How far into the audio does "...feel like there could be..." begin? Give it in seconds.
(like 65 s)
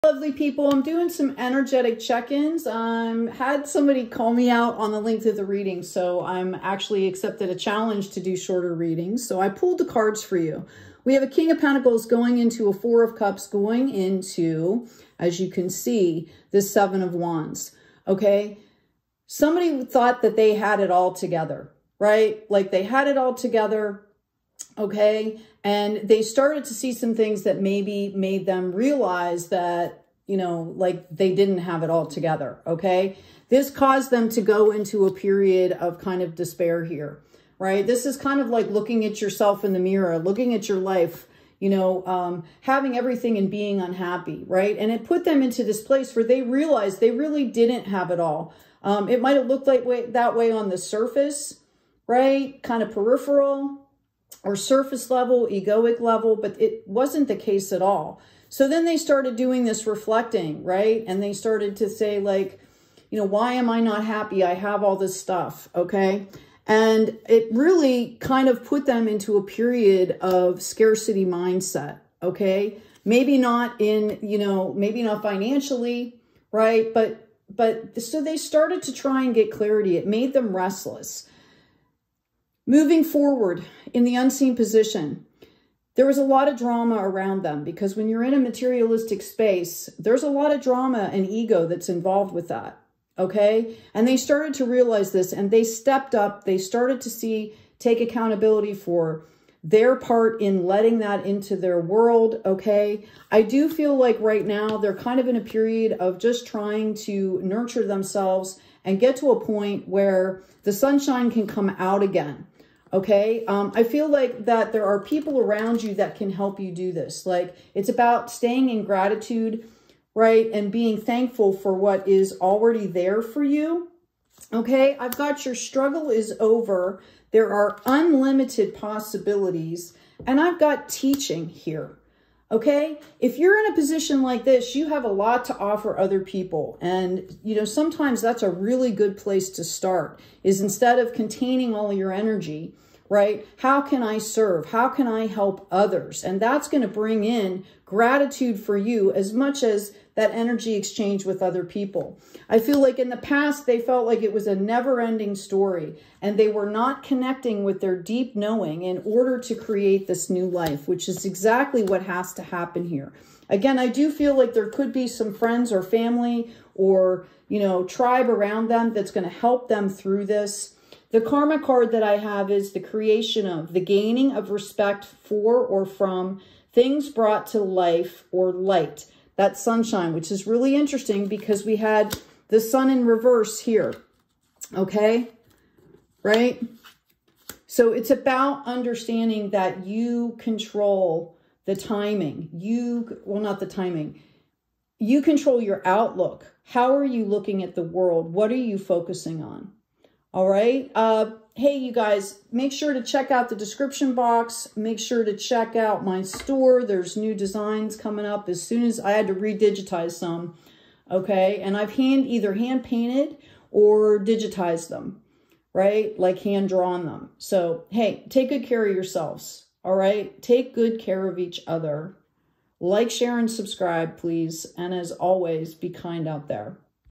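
164 s.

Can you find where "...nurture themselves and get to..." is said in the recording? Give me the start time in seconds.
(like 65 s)
107 s.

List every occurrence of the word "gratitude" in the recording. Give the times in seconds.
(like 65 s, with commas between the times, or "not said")
118 s, 147 s.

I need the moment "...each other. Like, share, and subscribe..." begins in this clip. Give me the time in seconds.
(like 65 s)
221 s.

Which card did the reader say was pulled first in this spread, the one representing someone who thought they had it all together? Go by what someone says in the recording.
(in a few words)
King of Pentacles.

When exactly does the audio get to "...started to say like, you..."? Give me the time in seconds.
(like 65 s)
61 s.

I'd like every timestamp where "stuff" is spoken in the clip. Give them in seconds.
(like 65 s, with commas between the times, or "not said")
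65 s.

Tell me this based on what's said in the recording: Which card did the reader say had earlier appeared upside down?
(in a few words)
The Sun.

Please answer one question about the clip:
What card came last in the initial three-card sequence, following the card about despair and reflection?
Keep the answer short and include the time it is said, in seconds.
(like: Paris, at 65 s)
Seven of Wands, at 16 s.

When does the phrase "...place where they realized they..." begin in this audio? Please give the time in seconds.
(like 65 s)
45 s.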